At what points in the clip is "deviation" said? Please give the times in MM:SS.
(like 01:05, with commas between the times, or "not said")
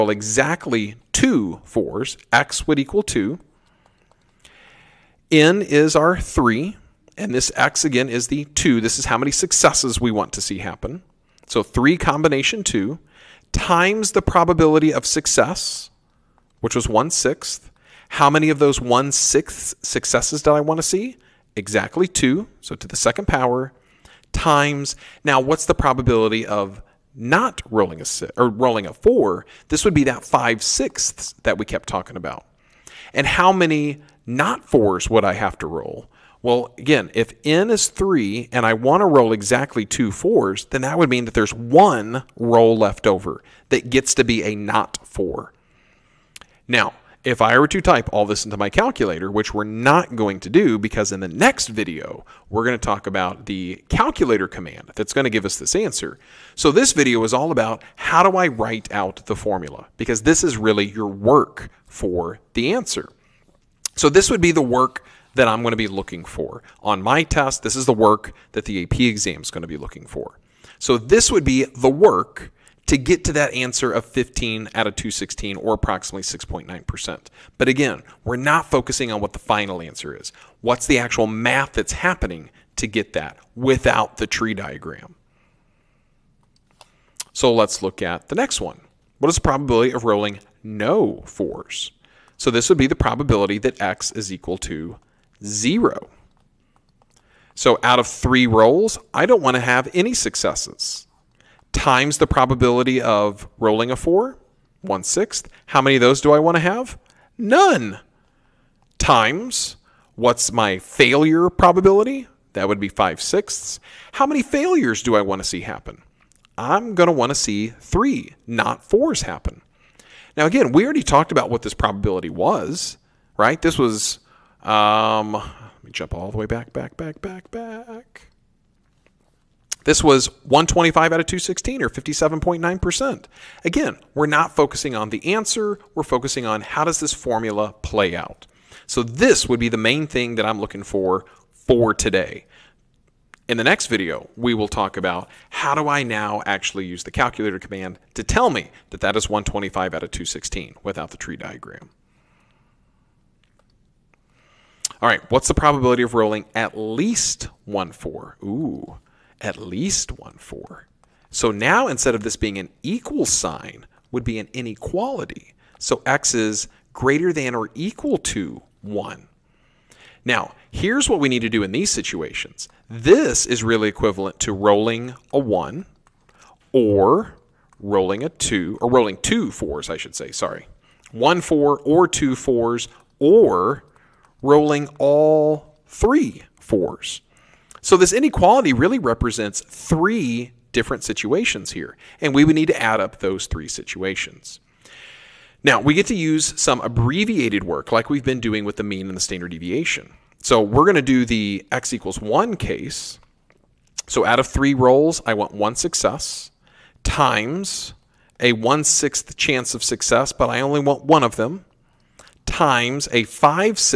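03:19.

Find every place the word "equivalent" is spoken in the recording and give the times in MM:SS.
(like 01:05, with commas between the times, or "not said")
02:53.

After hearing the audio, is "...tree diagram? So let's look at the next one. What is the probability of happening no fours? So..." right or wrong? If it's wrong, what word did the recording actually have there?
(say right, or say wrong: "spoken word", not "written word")
wrong: "rolling", not "happening".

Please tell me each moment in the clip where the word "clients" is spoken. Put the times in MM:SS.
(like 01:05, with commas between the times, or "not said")
not said.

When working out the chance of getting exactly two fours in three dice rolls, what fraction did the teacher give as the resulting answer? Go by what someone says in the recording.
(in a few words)
15/216.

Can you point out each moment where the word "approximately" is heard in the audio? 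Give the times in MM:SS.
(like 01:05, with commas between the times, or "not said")
01:15.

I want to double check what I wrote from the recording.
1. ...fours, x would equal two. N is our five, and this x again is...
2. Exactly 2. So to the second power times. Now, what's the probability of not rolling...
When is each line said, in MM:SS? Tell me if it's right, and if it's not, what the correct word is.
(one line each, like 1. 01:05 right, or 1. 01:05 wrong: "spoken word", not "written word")
1. 00:01 wrong: "three", not "five"
2. 00:21 right.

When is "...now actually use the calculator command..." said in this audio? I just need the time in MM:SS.
02:26.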